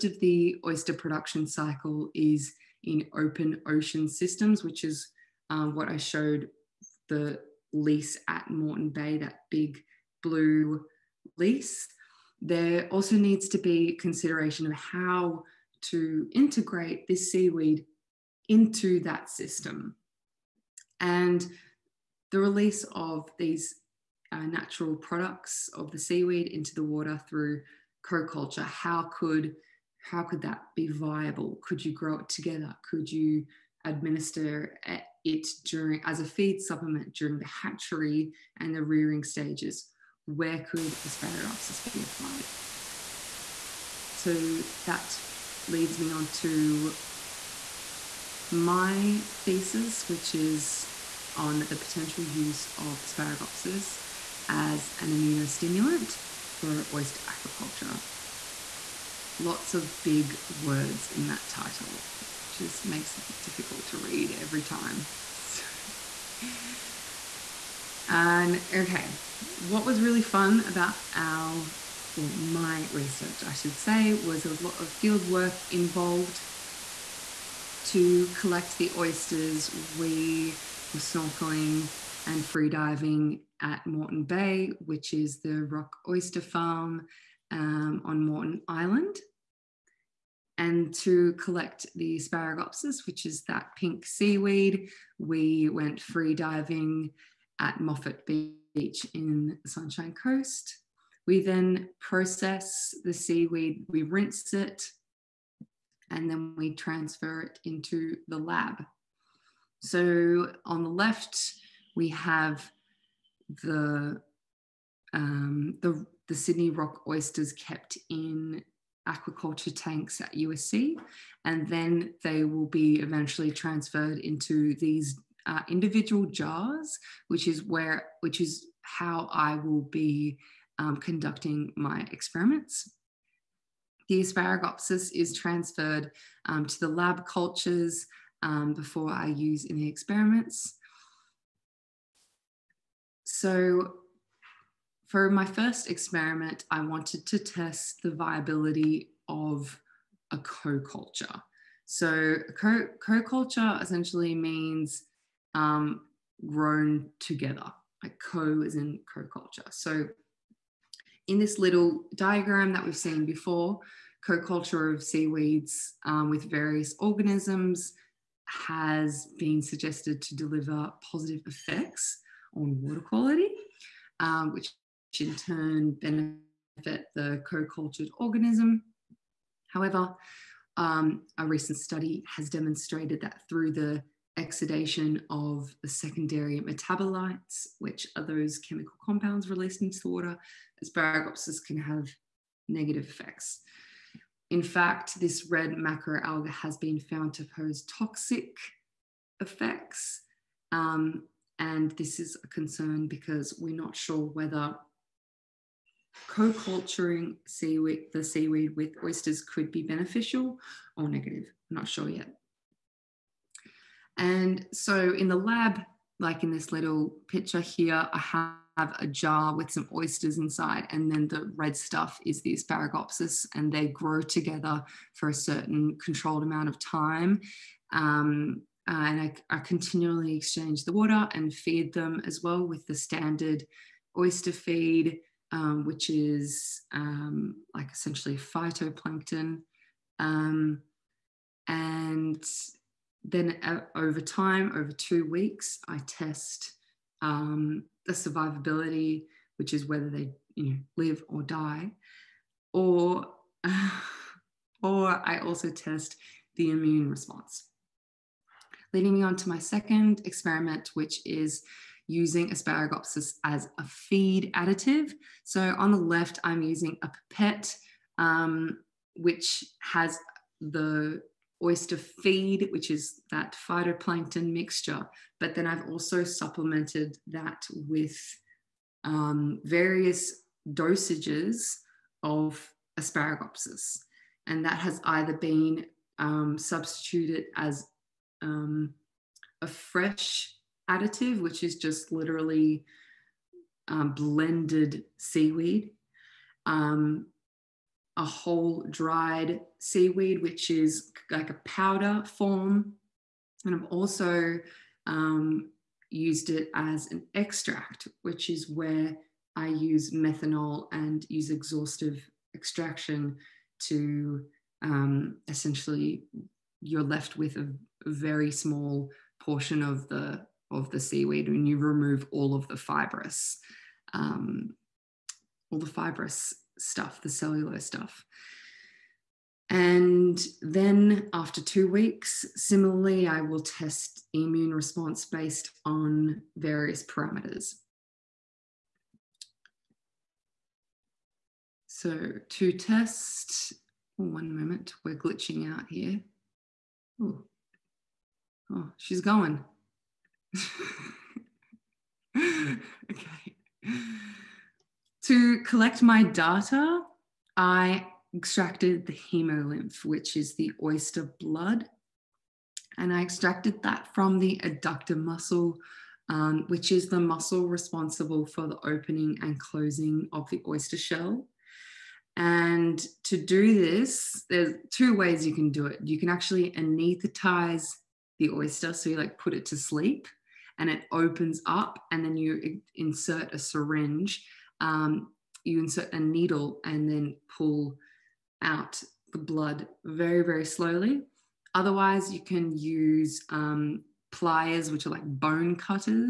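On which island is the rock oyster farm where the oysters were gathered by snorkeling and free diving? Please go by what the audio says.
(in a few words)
Moreton Island.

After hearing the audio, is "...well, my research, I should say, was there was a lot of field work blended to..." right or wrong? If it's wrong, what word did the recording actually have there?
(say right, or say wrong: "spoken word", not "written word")
wrong: "involved", not "blended".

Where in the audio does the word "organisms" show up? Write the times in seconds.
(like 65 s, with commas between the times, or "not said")
166 s, 178 s.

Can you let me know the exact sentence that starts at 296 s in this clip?
Um, a whole dried seaweed, which is like a powder form.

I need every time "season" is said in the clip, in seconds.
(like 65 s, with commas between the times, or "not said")
not said.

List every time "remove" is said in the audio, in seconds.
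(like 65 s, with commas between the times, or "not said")
321 s.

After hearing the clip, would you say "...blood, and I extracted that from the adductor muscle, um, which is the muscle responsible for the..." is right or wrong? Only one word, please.
right.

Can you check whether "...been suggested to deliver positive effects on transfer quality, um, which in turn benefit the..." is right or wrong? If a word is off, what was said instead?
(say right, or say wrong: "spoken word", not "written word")
wrong: "water", not "transfer".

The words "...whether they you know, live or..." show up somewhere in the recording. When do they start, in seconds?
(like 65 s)
249 s.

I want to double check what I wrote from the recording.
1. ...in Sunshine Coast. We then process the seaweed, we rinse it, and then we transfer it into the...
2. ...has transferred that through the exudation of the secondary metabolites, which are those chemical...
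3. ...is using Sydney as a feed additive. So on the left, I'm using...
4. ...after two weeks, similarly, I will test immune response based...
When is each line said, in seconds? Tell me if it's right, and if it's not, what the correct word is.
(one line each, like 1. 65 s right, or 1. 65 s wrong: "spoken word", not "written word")
1. 99 s right
2. 182 s wrong: "demonstrated", not "transferred"
3. 261 s wrong: "Asparagopsis", not "Sydney"
4. 331 s right.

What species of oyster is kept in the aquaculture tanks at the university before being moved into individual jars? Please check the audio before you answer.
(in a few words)
Sydney rock oysters.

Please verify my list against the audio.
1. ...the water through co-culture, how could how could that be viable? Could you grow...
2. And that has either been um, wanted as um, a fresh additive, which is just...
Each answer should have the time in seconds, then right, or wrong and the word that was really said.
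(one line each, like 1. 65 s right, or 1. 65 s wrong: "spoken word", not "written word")
1. 26 s right
2. 284 s wrong: "substituted", not "wanted".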